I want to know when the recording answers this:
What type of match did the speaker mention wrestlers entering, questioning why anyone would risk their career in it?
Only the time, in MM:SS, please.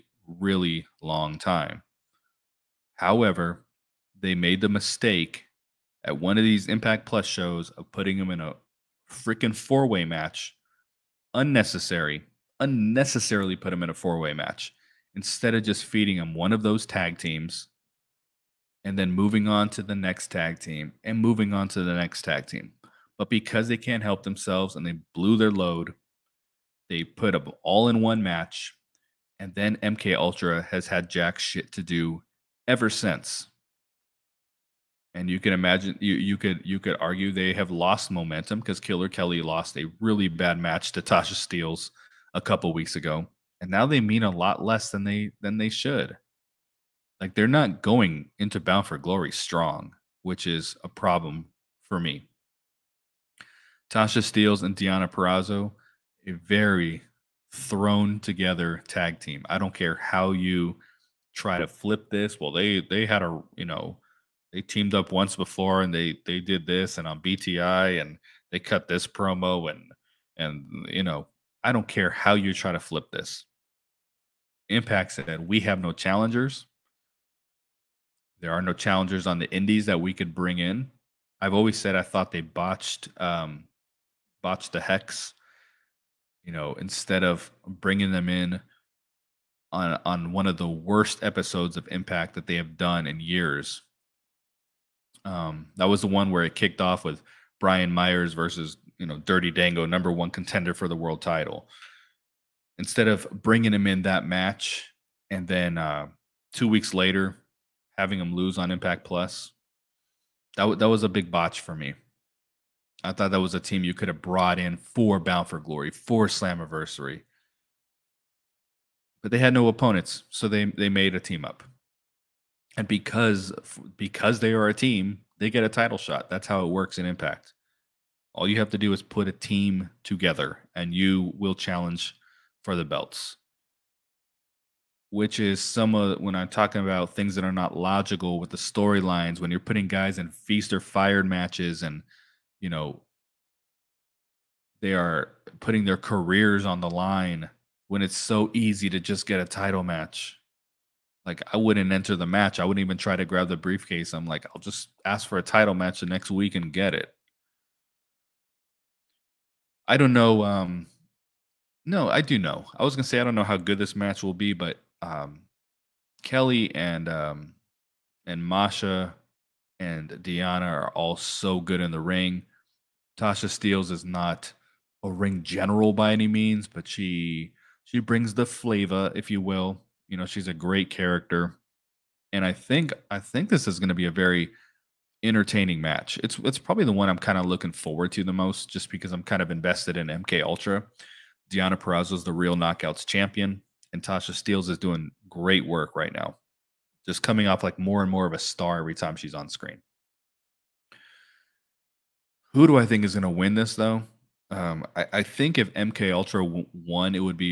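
02:20.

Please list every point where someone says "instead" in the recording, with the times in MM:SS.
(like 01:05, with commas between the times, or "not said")
00:15, 01:26, 01:42.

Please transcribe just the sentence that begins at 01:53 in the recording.
I thought that was a team you could have brought in for Bound for Glory, for Slammiversary.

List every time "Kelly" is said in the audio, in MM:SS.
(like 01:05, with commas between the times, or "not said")
00:39, 02:46.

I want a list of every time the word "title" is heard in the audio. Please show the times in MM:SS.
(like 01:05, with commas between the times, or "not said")
01:41, 02:05, 02:29, 02:35.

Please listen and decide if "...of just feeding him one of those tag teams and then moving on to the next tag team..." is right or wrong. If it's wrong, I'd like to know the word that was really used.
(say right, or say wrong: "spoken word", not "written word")
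right.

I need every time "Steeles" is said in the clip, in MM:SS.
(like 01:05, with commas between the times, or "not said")
00:41, 00:54, 02:53, 03:14.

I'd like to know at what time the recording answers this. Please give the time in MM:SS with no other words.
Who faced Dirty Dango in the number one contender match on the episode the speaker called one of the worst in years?
01:37.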